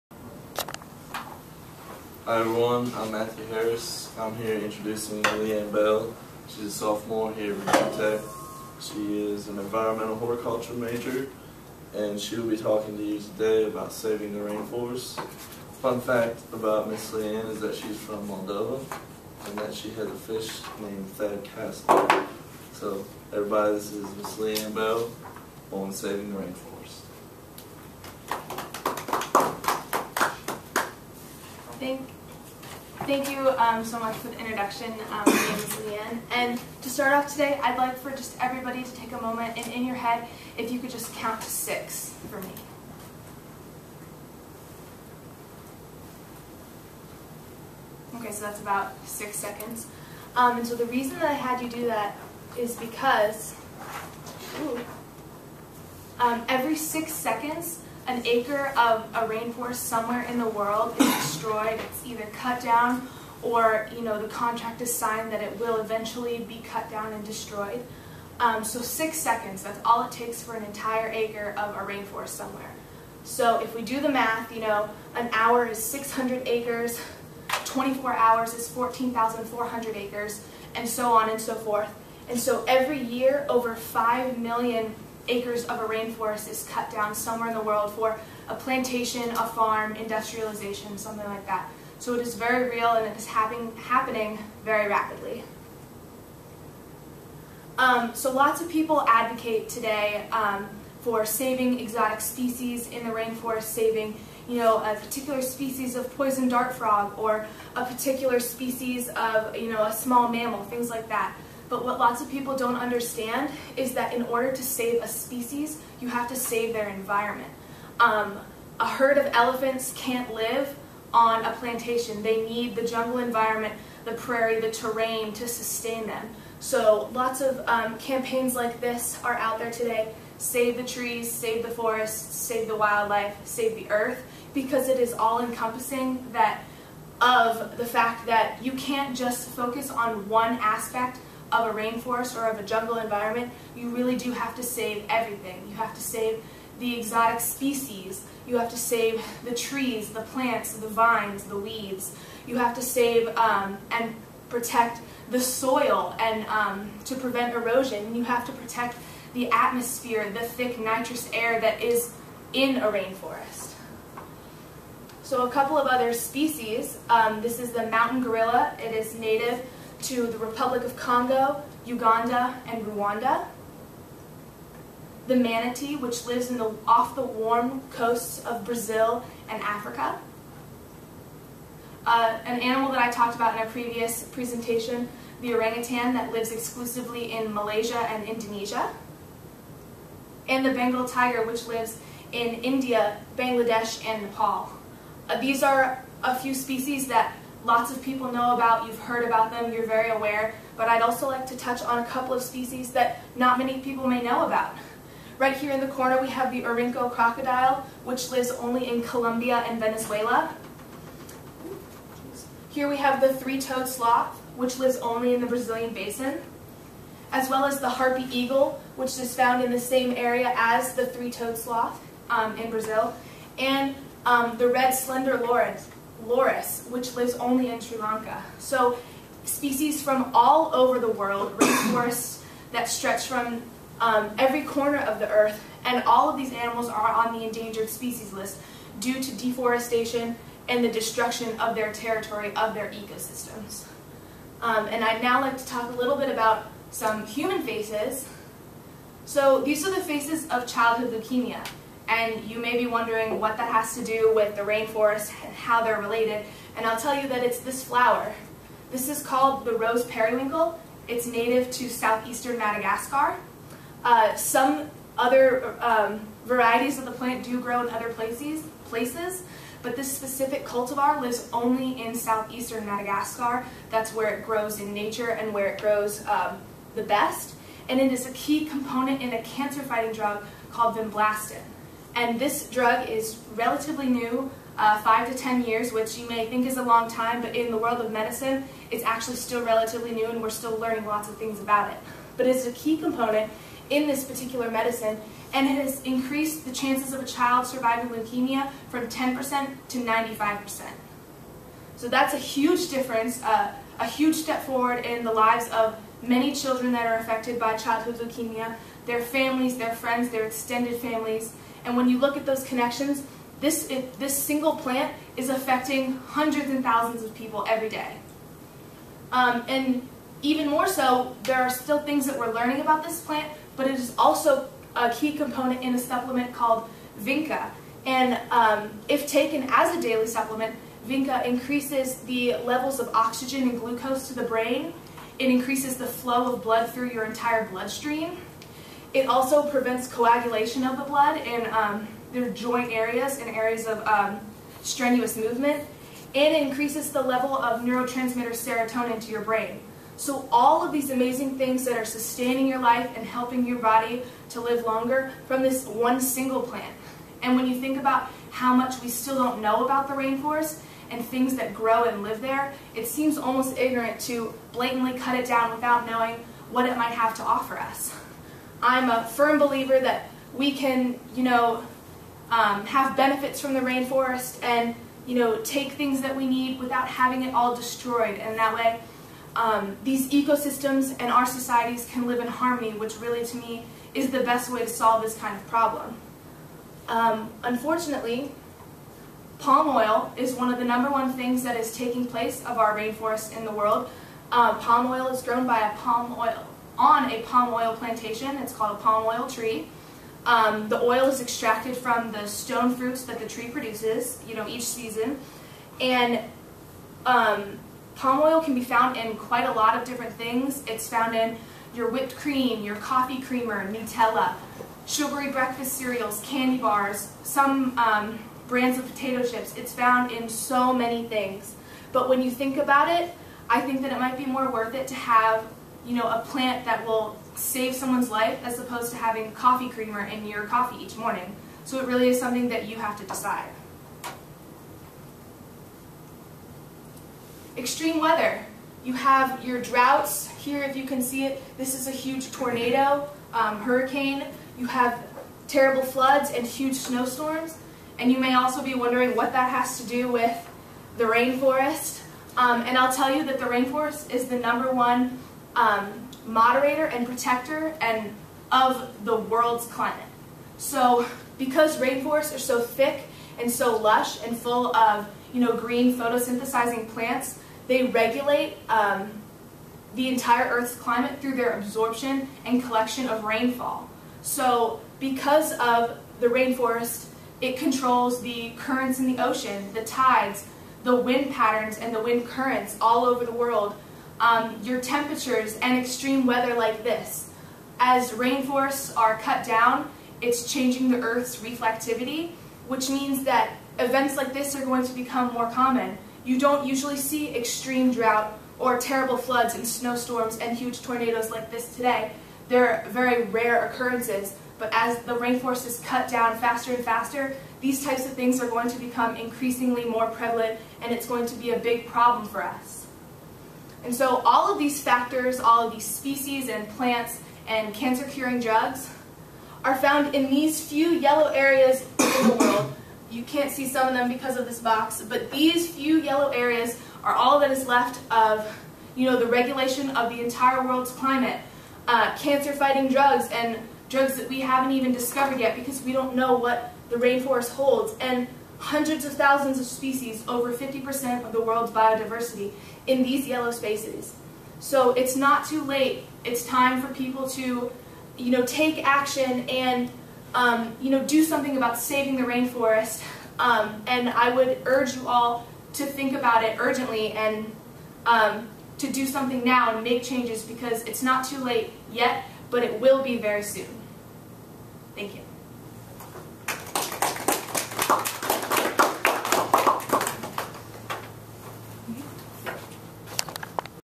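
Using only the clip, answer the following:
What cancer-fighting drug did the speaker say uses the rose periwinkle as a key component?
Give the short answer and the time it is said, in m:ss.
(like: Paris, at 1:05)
vinblastine, at 4:40.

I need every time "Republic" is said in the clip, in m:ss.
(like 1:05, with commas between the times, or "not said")
2:50.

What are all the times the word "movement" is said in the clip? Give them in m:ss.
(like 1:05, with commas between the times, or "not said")
5:45.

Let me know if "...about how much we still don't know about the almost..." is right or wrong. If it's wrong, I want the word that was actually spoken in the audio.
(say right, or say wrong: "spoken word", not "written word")
wrong: "rainforest", not "almost".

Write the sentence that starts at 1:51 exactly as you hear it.
But what lots of people don't understand is that in order to save a species, you have to save their environment.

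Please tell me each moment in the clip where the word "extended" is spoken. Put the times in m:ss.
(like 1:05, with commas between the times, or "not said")
5:10.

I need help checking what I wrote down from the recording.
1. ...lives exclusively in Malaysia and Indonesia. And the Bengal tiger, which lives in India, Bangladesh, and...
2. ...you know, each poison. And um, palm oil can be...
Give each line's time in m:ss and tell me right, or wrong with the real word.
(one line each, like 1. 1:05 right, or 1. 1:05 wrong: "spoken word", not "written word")
1. 3:06 right
2. 6:44 wrong: "season", not "poison".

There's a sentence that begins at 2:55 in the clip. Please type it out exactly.
The manatee, which lives the, off the warm coasts of Brazil and Africa.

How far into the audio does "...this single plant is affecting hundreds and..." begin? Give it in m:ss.
5:14.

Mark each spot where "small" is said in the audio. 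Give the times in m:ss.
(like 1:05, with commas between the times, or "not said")
1:49.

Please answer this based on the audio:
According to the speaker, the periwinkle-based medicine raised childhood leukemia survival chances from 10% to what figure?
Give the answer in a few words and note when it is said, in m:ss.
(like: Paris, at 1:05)
95%, at 4:59.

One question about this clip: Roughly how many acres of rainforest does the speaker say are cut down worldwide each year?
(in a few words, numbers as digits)
over 5 million acres.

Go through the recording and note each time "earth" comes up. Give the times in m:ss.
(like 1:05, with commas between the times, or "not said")
2:13, 3:55, 7:50, 8:11.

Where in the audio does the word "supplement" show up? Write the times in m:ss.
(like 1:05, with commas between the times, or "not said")
5:25, 5:30.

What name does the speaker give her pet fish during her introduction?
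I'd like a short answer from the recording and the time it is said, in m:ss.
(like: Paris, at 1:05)
Thad Castle, at 0:21.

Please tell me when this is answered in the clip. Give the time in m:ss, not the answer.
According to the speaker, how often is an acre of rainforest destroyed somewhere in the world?
0:56.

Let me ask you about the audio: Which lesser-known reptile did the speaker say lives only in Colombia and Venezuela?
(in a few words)
Orinoco crocodile.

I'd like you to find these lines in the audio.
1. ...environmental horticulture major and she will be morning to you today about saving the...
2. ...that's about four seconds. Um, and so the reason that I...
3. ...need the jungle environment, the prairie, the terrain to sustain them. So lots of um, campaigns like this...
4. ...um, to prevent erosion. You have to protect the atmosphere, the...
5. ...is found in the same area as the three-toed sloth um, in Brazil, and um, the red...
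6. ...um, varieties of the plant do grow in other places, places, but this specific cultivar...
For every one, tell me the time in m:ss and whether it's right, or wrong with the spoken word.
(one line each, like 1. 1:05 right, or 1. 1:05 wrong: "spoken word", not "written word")
1. 0:09 wrong: "talking", not "morning"
2. 0:48 wrong: "six", not "four"
3. 2:02 right
4. 2:36 right
5. 3:39 right
6. 4:25 right.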